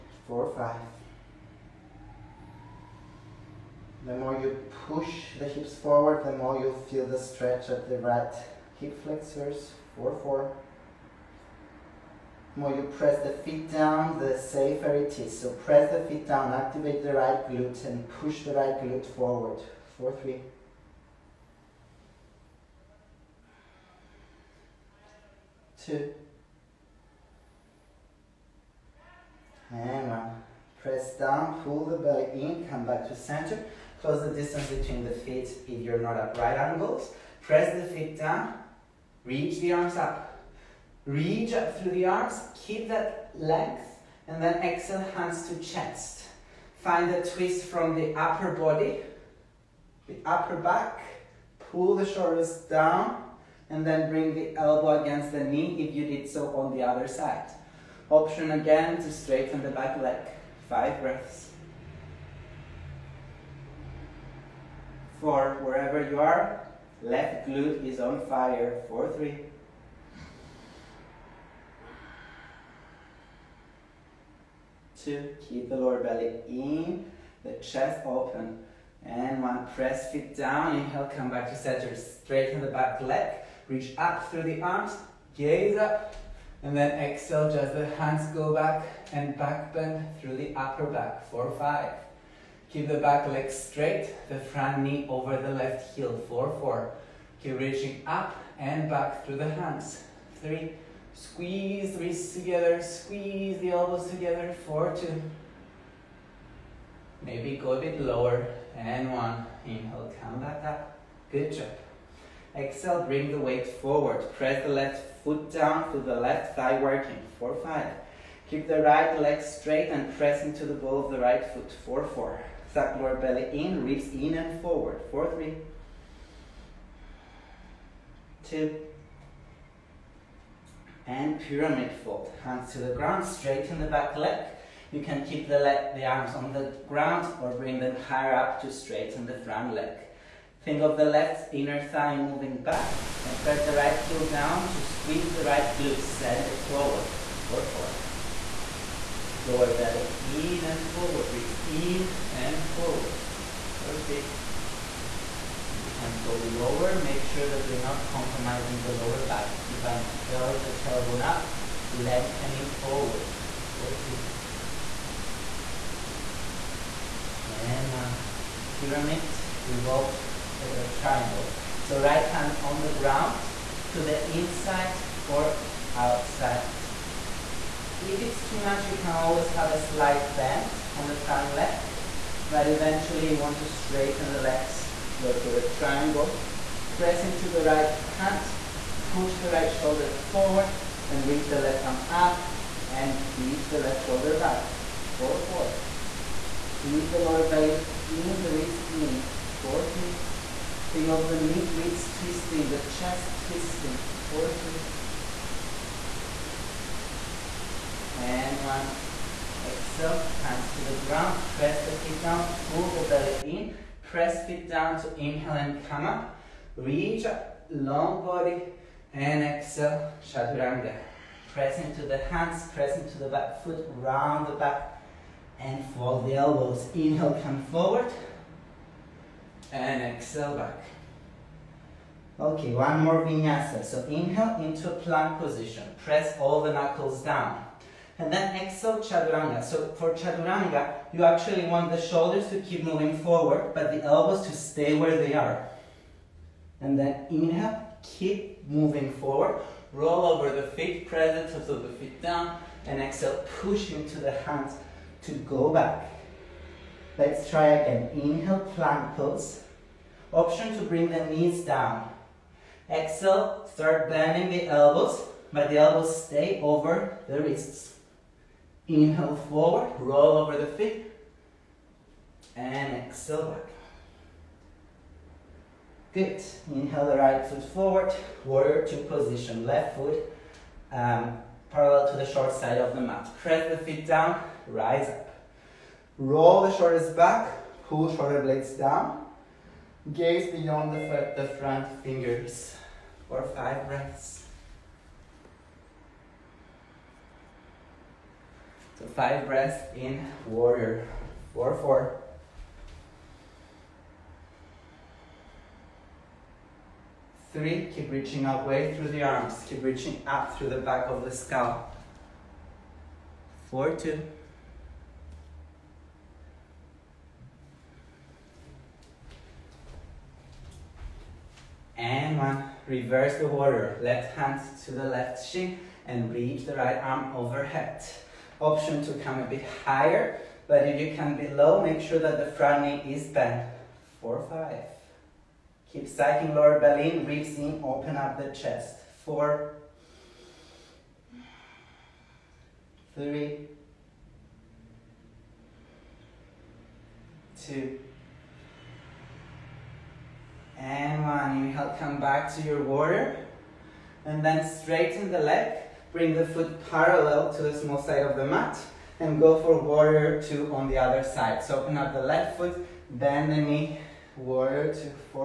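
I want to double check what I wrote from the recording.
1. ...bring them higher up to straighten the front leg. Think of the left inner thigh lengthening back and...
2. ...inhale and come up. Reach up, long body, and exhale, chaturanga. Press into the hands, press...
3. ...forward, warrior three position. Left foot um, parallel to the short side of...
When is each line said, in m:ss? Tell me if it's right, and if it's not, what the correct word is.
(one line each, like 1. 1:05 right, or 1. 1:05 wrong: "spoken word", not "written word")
1. 2:17 wrong: "moving", not "lengthening"
2. 3:35 right
3. 4:37 wrong: "two", not "three".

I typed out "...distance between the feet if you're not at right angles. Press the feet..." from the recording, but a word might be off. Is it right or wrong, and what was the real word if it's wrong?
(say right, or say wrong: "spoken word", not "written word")
right.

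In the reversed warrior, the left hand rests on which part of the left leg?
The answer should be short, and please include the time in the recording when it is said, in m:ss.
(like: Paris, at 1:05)
Shin, at 5:25.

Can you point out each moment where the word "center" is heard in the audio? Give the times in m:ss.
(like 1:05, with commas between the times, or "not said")
0:33, 1:21.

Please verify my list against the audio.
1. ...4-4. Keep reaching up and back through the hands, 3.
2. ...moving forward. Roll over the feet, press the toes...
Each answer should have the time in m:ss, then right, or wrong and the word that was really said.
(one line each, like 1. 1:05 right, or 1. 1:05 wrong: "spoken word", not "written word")
1. 1:36 right
2. 4:08 right.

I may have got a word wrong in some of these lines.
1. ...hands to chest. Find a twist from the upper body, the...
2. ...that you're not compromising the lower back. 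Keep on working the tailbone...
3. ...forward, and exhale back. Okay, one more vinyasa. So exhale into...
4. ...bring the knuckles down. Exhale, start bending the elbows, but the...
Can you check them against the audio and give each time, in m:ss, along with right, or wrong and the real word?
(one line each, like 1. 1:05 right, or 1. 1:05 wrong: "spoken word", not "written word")
1. 0:45 right
2. 2:37 wrong: "curling", not "working"
3. 3:47 wrong: "inhale", not "exhale"
4. 4:20 wrong: "knees", not "knuckles".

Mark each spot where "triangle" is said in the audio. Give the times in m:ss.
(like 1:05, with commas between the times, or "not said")
2:50, 3:05.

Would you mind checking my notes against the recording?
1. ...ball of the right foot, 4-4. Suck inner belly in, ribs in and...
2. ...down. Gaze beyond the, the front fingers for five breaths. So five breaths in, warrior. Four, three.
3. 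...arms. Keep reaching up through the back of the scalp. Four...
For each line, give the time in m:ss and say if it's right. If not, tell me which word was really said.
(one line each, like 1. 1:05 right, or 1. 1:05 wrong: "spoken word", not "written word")
1. 2:00 wrong: "lower", not "inner"
2. 4:48 wrong: "four", not "three"
3. 5:09 right.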